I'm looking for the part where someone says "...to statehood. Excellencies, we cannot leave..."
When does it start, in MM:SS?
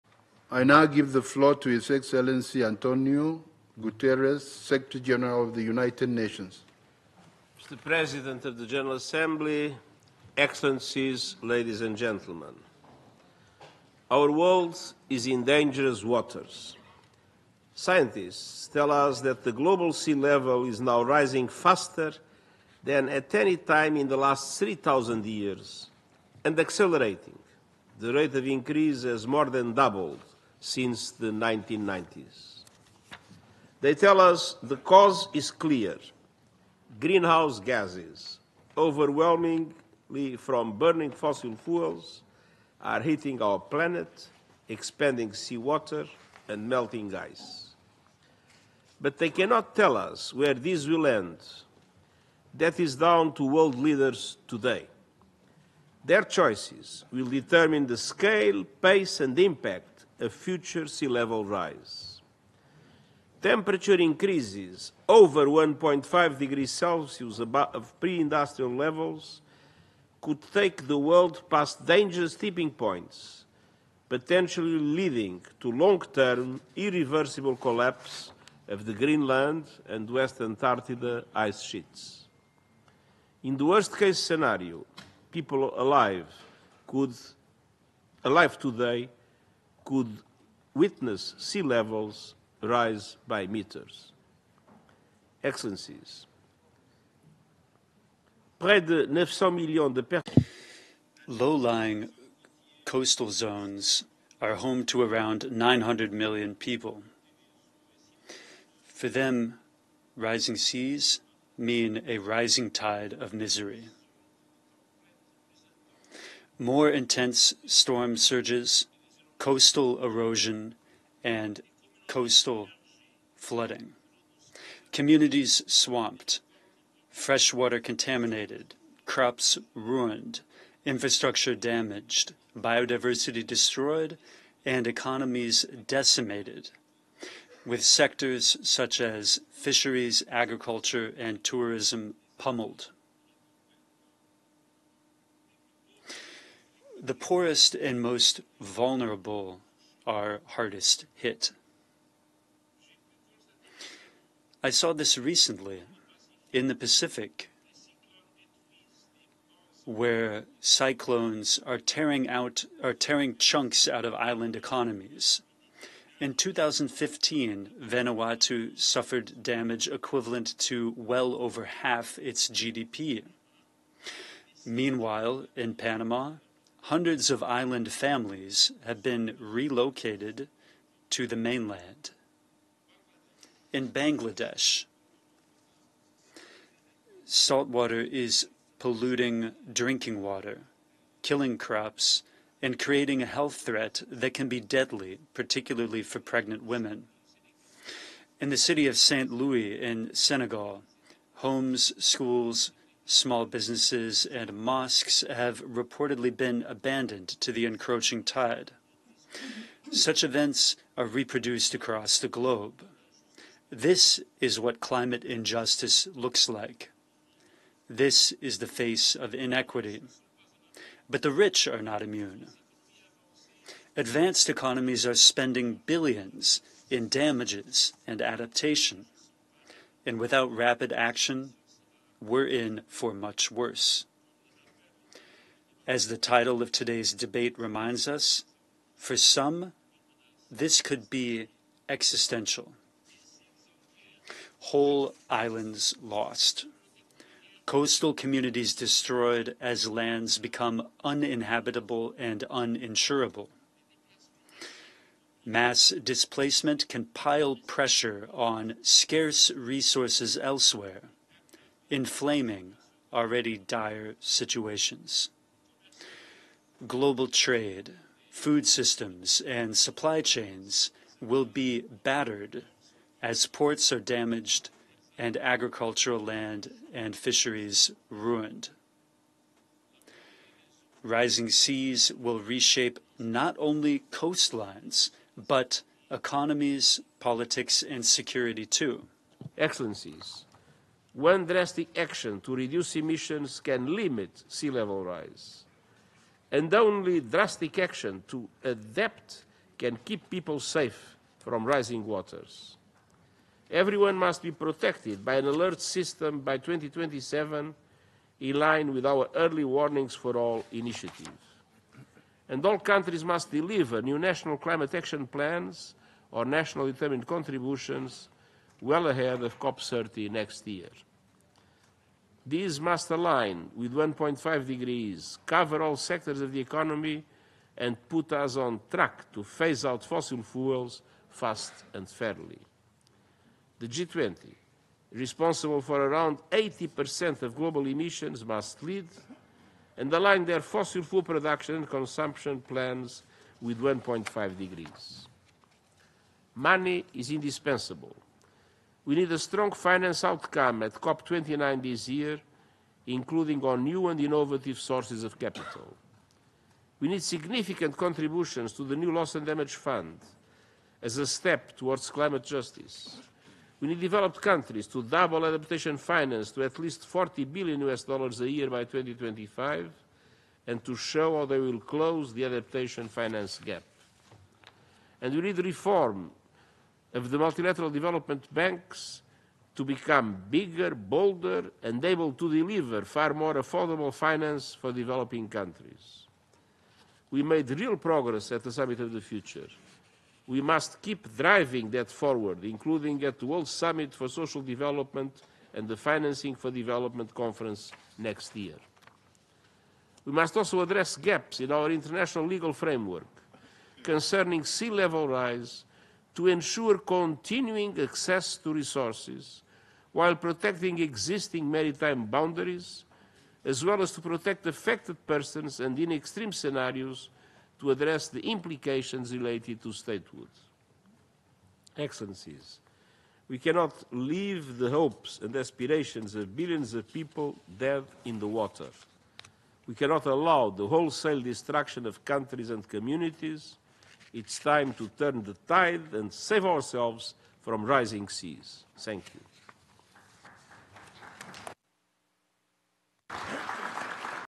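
06:59.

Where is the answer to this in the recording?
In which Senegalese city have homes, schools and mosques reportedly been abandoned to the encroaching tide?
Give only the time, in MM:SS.
03:18.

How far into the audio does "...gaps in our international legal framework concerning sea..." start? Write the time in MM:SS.
06:41.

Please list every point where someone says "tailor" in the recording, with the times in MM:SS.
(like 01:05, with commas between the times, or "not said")
not said.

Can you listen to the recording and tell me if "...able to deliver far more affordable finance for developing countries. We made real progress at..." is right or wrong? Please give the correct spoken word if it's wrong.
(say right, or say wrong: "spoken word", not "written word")
right.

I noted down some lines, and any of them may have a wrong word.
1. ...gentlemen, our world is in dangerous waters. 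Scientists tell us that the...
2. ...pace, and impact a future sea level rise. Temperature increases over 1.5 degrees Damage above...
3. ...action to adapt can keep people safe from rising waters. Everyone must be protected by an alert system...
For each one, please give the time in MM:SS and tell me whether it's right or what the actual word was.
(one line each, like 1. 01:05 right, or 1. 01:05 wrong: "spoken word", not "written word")
1. 00:11 right
2. 00:58 wrong: "Celsius", not "Damage"
3. 04:57 right.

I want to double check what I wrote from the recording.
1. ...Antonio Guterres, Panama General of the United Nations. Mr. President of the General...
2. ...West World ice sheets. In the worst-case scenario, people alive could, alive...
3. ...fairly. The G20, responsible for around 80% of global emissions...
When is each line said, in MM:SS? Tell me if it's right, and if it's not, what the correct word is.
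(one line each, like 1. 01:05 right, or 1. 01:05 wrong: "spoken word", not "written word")
1. 00:02 wrong: "Secretary", not "Panama"
2. 01:20 wrong: "Antarctica", not "World"
3. 05:32 right.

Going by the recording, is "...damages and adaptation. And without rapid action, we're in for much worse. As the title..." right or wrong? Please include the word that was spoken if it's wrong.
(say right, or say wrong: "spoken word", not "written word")
right.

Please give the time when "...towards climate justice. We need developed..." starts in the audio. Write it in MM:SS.
06:01.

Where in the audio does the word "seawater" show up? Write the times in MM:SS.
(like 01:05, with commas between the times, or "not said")
00:45.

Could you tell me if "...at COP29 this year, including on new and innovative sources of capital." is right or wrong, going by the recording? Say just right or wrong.
right.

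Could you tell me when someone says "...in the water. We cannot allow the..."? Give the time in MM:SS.
07:08.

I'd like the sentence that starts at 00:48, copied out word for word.
But they cannot tell us where this will end.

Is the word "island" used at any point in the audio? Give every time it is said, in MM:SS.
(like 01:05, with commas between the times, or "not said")
02:44, 02:57, 04:05.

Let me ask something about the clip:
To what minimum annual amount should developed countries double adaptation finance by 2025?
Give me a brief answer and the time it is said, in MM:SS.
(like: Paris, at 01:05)
40 billion US dollars, at 06:07.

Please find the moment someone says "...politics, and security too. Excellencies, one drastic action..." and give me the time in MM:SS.
04:47.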